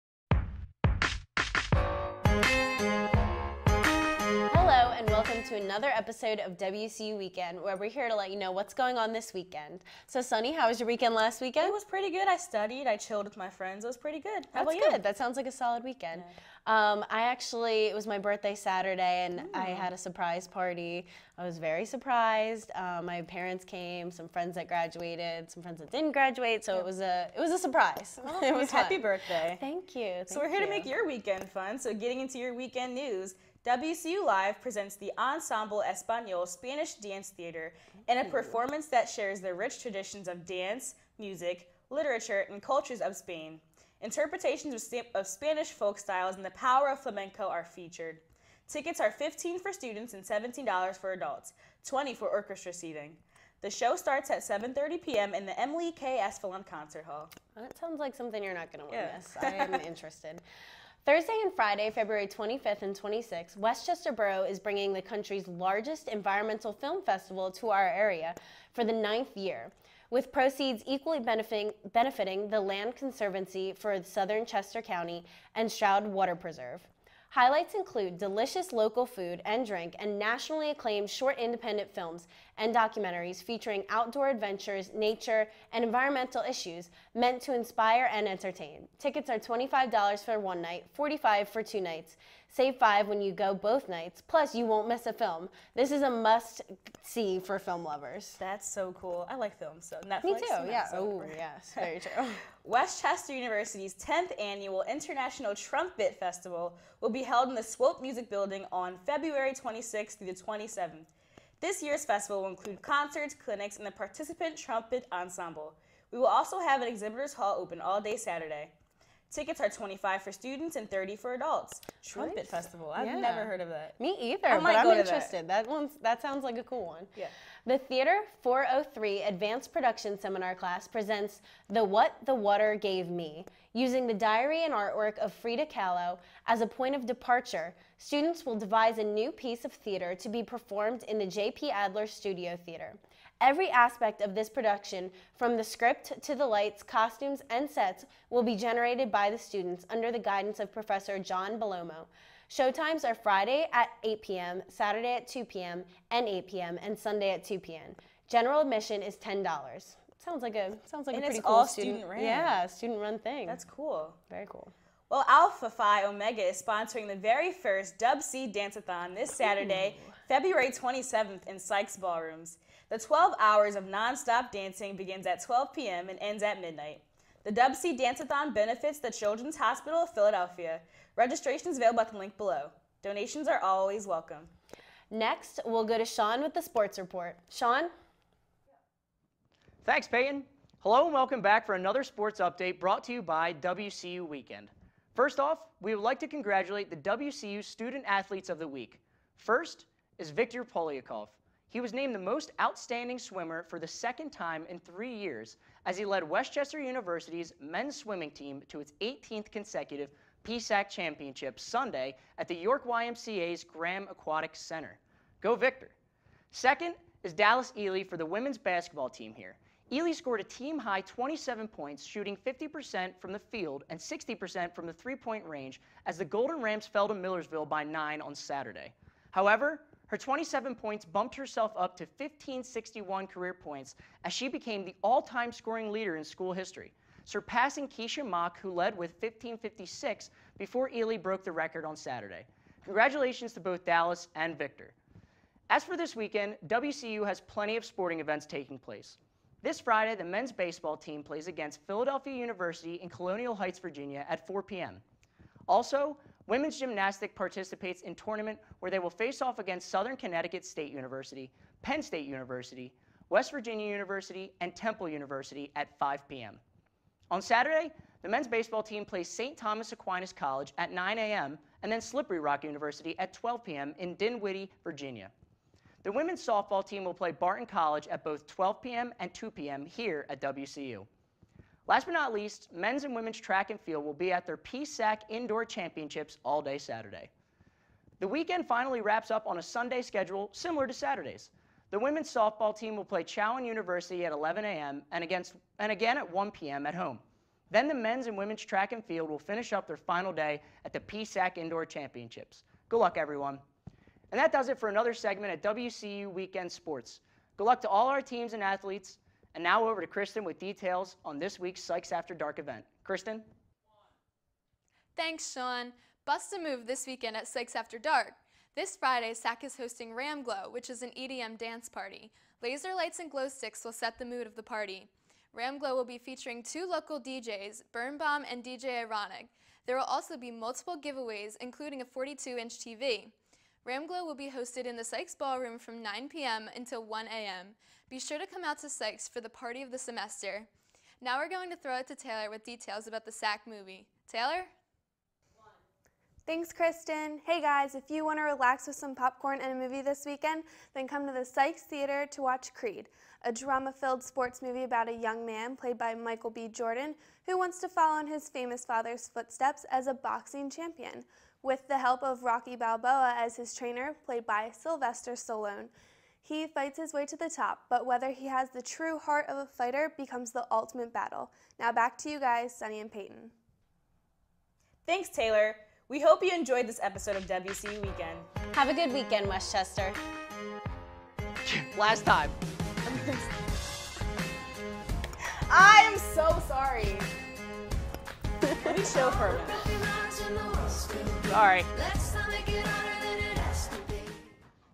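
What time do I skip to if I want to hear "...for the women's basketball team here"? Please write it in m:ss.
3:38.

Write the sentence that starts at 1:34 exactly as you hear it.
Plus, you won't miss a film.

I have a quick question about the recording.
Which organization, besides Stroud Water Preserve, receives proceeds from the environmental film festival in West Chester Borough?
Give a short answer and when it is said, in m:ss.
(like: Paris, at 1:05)
Land Conservancy for Southern Chester County, at 1:12.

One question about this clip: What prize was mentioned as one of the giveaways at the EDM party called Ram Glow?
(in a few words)
42-inch TV.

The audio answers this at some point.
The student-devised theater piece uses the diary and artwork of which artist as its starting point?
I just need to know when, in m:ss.
2:15.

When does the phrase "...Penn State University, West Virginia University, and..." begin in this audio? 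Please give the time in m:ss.
4:21.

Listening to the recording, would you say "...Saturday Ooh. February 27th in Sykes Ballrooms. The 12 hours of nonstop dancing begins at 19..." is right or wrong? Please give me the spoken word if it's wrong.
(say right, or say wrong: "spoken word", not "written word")
wrong: "12", not "19".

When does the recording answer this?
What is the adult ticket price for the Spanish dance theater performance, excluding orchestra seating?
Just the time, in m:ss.
0:50.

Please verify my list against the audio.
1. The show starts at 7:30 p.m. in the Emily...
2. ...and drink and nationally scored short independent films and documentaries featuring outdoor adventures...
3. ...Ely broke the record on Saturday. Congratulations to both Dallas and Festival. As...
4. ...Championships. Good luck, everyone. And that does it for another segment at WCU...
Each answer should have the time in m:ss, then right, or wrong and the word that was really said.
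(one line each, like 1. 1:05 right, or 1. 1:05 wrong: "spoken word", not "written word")
1. 0:53 right
2. 1:19 wrong: "acclaimed", not "scored"
3. 4:00 wrong: "Victor", not "Festival"
4. 5:01 right.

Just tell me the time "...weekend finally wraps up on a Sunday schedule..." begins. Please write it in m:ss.
4:48.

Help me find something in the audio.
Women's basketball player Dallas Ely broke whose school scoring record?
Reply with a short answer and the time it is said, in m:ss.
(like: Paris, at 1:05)
Keisha Mock, at 3:57.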